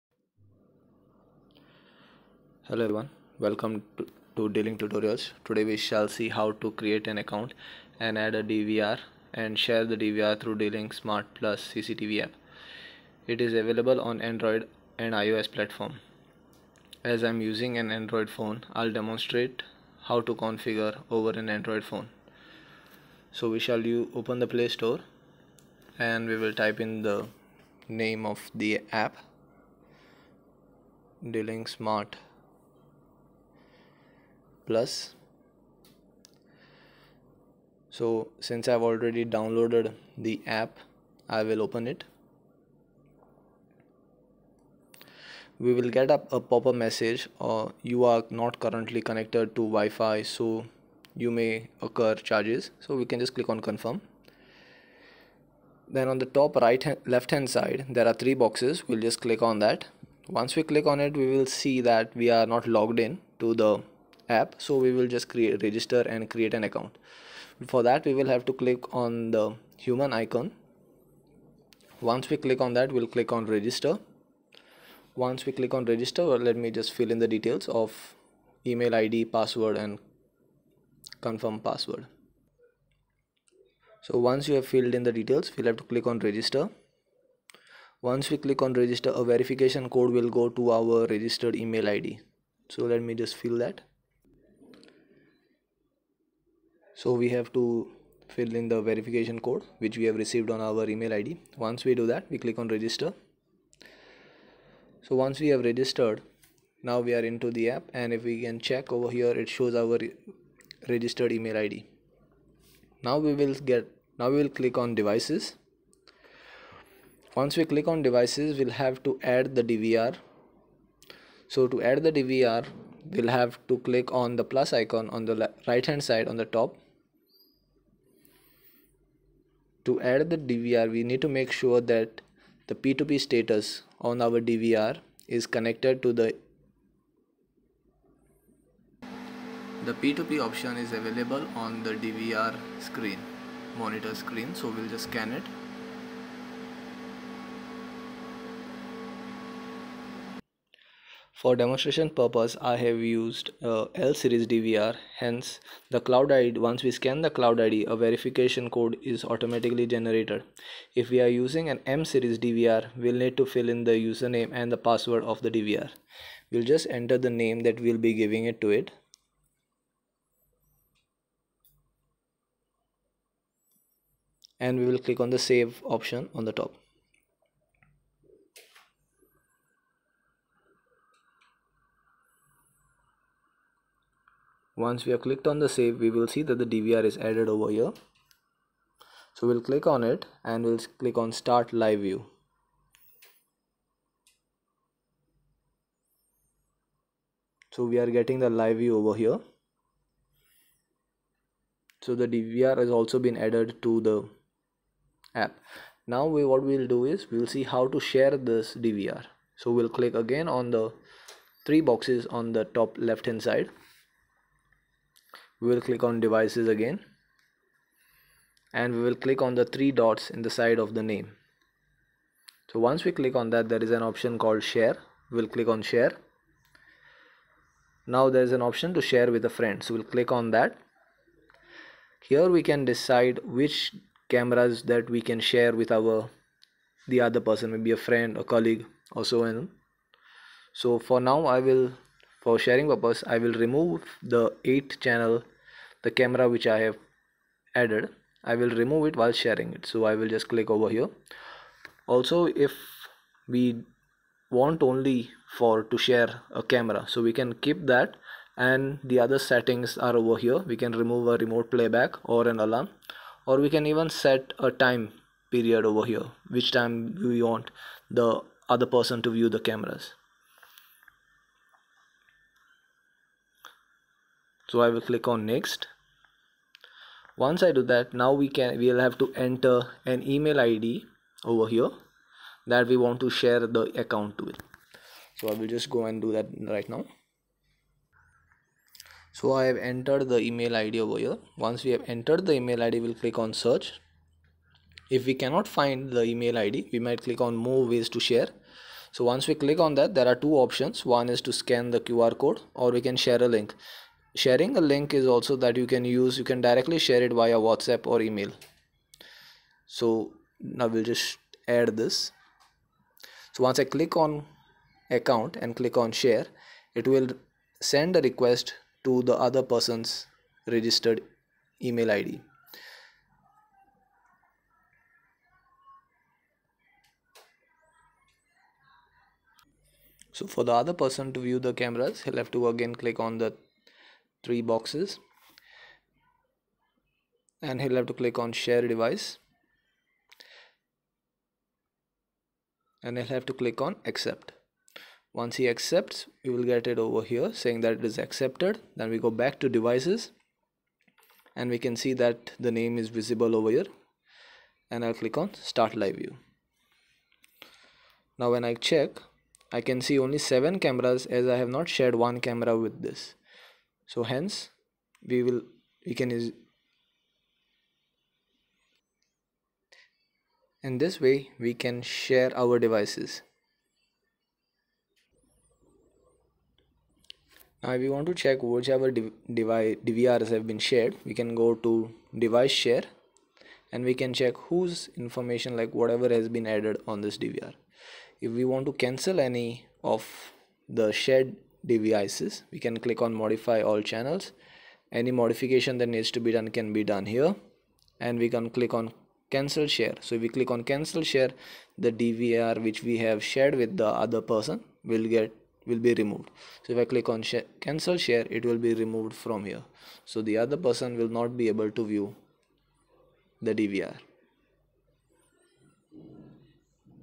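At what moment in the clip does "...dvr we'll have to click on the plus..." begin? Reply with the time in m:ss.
2:02.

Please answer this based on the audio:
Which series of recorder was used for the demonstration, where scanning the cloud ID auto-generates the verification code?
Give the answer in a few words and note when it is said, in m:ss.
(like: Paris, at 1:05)
L series, at 2:33.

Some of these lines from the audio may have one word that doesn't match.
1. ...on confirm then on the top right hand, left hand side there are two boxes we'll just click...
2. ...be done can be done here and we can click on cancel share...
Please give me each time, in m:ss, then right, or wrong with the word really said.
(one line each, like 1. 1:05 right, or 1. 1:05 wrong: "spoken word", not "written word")
1. 0:53 wrong: "three", not "two"
2. 6:36 right.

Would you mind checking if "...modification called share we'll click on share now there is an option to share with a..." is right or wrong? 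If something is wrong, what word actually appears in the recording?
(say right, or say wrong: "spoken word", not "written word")
wrong: "option", not "modification".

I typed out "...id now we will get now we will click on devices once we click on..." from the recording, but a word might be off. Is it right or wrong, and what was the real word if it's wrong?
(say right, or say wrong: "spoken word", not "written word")
right.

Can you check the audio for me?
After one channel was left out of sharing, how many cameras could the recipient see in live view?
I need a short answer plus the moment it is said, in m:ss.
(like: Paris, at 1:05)
7, at 6:00.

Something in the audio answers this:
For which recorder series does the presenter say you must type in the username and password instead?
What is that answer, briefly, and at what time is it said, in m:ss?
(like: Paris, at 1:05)
M series, at 2:41.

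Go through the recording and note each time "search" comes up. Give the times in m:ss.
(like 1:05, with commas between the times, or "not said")
4:53.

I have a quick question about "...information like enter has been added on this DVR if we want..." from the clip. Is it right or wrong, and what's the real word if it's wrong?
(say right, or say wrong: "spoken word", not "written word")
wrong: "whatever", not "enter".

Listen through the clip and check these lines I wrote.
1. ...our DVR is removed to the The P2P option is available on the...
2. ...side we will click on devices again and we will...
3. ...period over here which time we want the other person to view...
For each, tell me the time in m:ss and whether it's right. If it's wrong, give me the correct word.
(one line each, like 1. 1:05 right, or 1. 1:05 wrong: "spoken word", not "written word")
1. 2:14 wrong: "connected", not "removed"
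2. 3:33 right
3. 4:25 right.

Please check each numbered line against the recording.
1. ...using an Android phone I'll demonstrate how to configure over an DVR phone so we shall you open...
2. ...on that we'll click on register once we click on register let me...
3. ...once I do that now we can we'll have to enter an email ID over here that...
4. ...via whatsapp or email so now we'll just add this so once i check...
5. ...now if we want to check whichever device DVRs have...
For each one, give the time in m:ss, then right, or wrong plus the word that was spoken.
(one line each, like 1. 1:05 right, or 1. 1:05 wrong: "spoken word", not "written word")
1. 0:17 wrong: "Android", not "DVR"
2. 1:12 right
3. 4:37 right
4. 5:07 wrong: "click", not "check"
5. 6:17 right.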